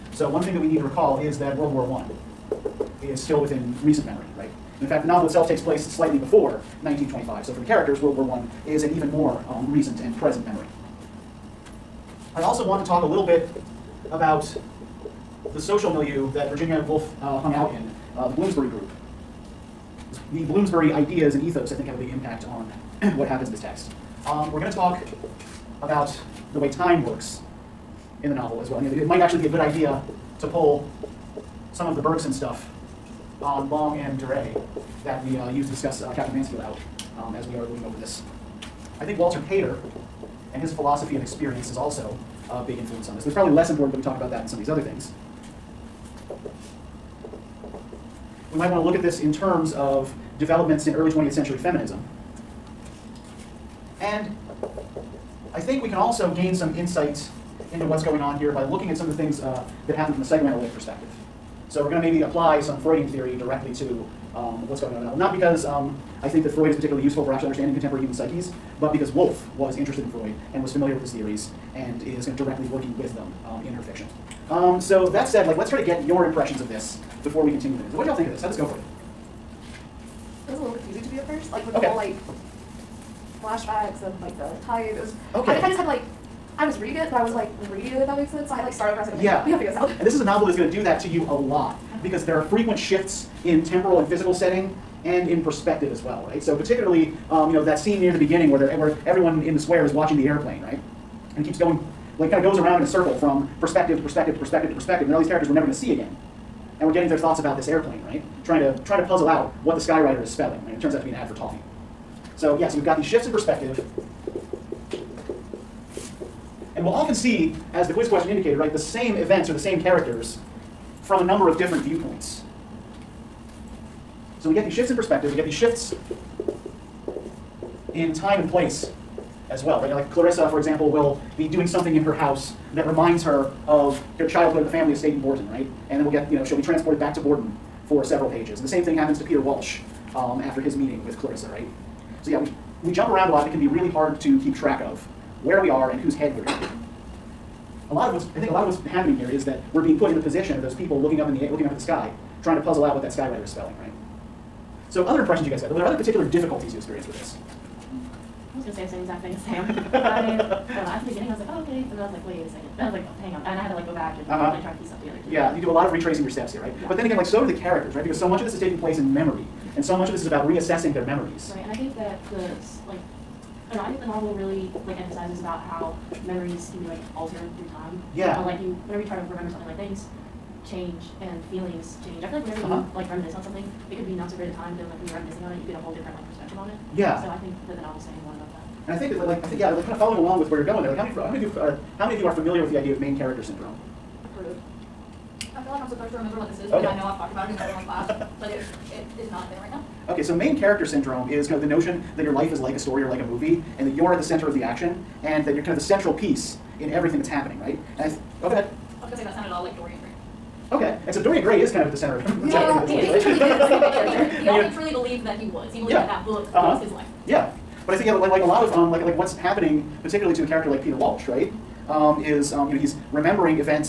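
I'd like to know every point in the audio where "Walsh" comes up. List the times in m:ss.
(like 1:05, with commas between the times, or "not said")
2:19, 3:40.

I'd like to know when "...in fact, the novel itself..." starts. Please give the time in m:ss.
0:04.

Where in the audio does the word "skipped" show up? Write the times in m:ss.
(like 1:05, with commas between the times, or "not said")
not said.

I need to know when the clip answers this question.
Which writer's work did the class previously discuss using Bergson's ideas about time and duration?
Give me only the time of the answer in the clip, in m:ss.
0:36.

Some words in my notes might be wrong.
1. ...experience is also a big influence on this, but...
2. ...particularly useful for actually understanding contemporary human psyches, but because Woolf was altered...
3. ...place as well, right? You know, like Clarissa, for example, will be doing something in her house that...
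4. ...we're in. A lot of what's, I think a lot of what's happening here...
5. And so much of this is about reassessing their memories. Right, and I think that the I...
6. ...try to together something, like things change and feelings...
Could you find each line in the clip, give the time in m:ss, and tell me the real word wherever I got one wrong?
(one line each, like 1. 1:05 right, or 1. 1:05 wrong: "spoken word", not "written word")
1. 0:41 right
2. 1:06 wrong: "interested", not "altered"
3. 2:08 right
4. 2:26 right
5. 2:49 right
6. 2:59 wrong: "remember", not "together".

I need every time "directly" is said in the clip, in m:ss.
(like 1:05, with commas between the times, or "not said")
1:03, 1:12.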